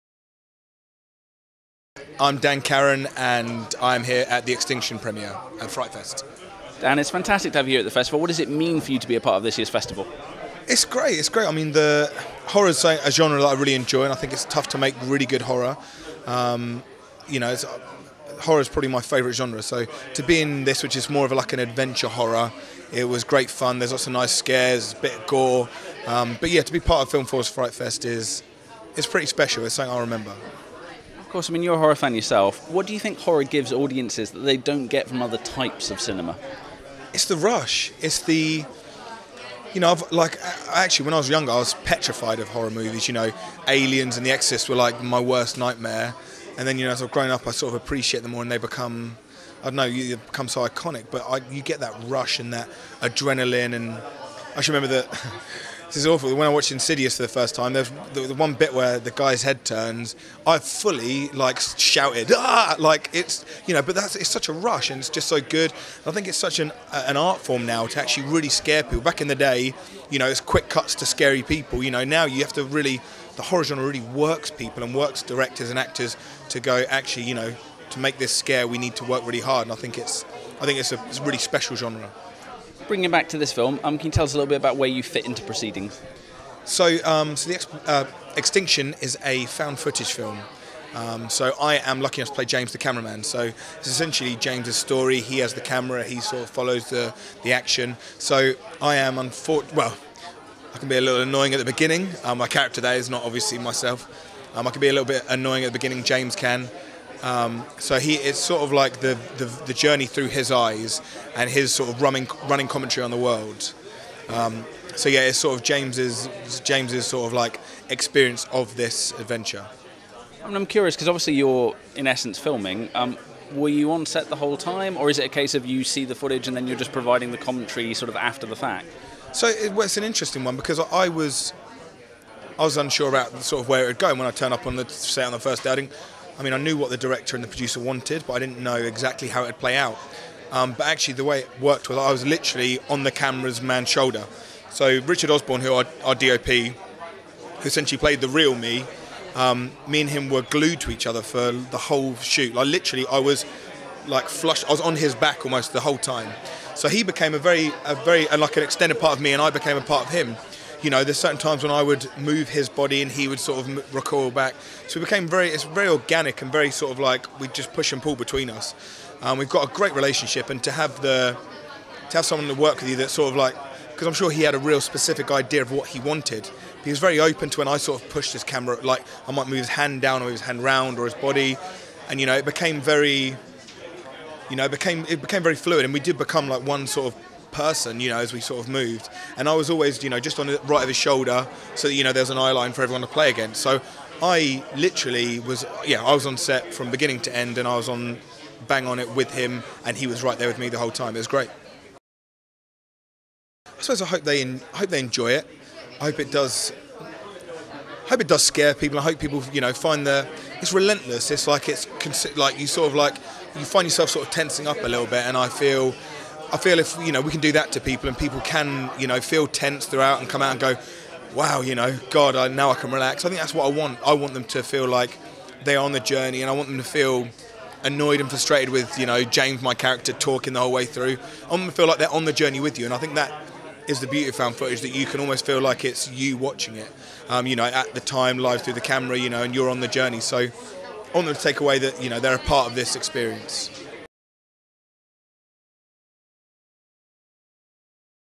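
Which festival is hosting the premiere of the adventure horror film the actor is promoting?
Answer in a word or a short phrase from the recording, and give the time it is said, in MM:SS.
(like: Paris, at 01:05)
FrightFest, at 00:05.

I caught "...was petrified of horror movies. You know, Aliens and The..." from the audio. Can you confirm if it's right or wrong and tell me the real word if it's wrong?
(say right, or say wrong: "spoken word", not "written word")
right.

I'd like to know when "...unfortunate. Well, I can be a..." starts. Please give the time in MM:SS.
01:39.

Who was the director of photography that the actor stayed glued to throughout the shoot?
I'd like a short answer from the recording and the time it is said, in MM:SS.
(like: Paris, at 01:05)
Richard Osborne, at 02:25.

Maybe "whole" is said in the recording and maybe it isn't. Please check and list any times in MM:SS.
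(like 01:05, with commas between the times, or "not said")
02:04, 02:31, 02:35, 03:20, 03:50.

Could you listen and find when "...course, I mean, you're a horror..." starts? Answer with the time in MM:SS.
00:31.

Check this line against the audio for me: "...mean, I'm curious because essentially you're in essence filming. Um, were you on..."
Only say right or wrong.
wrong.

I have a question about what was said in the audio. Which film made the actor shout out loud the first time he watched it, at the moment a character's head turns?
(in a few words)
Insidious.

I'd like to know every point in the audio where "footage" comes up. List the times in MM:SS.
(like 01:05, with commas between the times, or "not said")
01:29, 02:06, 03:54.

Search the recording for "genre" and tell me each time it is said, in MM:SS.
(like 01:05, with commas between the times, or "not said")
00:13, 00:19, 01:13, 01:21.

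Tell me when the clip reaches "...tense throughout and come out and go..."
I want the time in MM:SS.
03:39.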